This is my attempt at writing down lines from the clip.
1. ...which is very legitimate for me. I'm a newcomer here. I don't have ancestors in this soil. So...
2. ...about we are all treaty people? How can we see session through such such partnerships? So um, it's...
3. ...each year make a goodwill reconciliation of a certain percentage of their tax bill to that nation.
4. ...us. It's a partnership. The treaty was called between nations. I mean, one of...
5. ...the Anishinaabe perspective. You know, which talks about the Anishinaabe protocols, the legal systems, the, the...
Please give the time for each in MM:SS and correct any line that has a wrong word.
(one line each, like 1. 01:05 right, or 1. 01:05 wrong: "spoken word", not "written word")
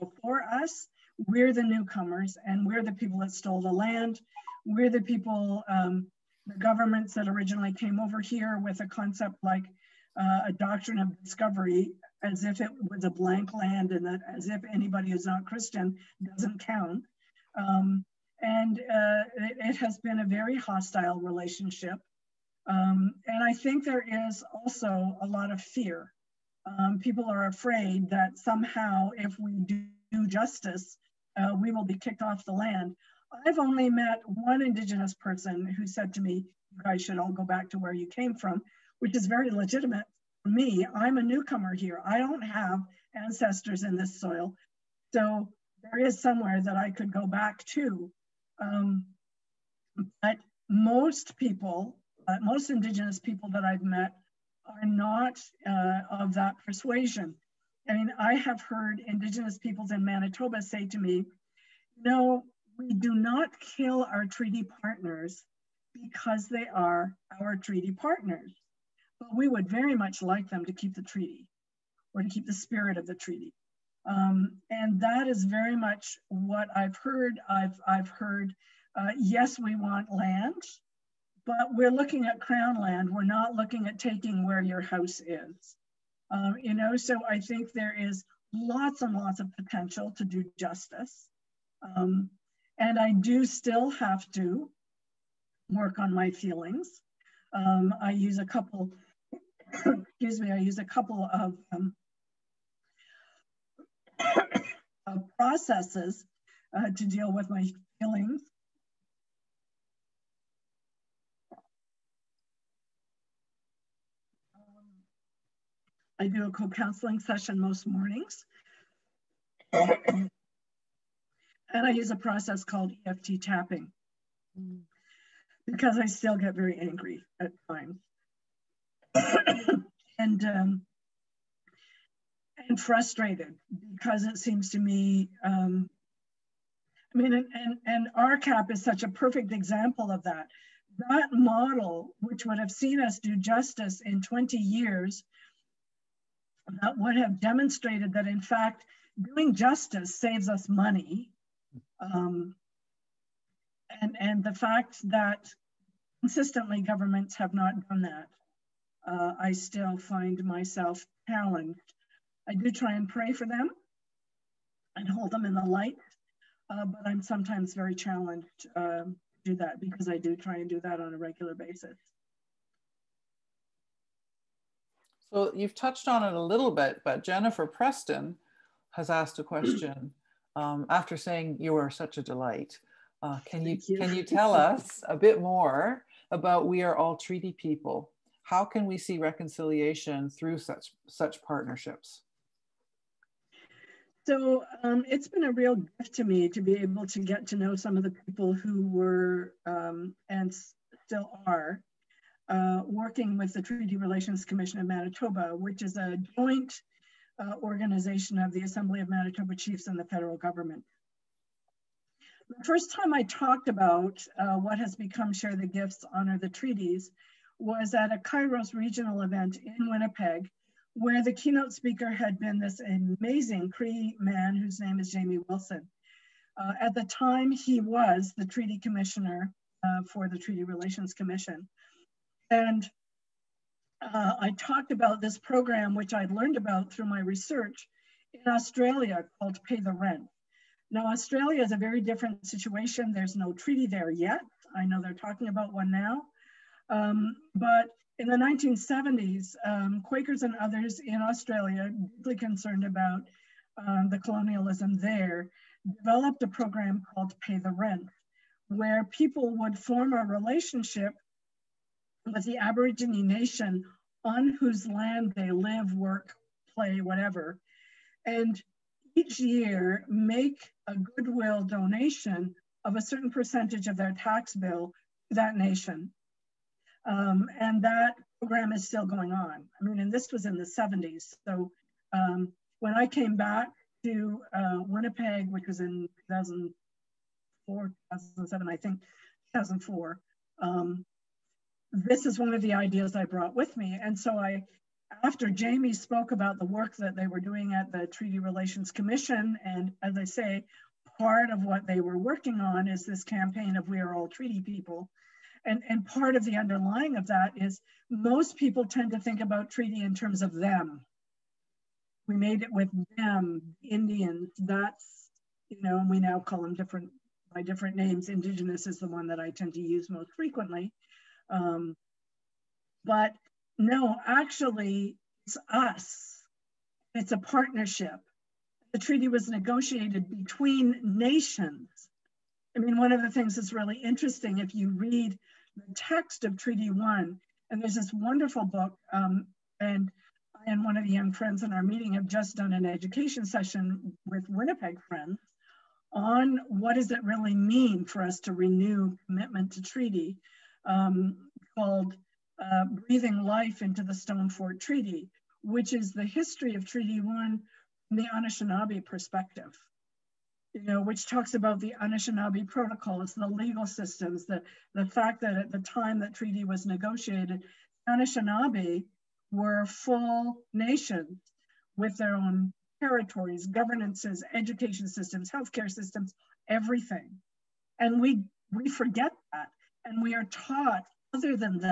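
1. 00:38 right
2. 03:06 wrong: "reconciliation", not "session"
3. 04:29 wrong: "donation", not "reconciliation"
4. 05:25 wrong: "negotiated", not "called"
5. 05:58 right.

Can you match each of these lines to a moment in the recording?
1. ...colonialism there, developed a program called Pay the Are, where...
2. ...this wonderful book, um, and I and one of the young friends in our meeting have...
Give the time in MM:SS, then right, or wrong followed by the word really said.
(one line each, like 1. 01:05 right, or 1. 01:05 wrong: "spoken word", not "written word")
1. 04:14 wrong: "Rent", not "Are"
2. 05:37 right.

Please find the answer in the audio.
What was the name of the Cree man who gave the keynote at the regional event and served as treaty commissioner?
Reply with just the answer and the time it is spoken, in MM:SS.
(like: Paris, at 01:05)
Jamie Wilson, at 03:45.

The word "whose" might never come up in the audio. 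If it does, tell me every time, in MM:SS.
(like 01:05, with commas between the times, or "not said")
03:44, 04:24.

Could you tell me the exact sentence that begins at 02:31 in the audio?
Um, and, and the fact that consistently governments have not done that, uh, I still find myself challenged.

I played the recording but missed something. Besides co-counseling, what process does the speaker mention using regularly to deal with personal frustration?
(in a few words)
EFT tapping.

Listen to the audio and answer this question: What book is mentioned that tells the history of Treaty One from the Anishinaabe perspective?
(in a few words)
Breathing Life into the Stone Fort Treaty.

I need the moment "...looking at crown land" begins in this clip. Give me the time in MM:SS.
01:21.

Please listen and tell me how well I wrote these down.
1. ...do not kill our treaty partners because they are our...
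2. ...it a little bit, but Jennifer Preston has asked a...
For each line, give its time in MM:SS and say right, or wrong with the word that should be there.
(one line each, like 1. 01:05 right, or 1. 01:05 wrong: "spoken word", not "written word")
1. 01:02 right
2. 02:56 right.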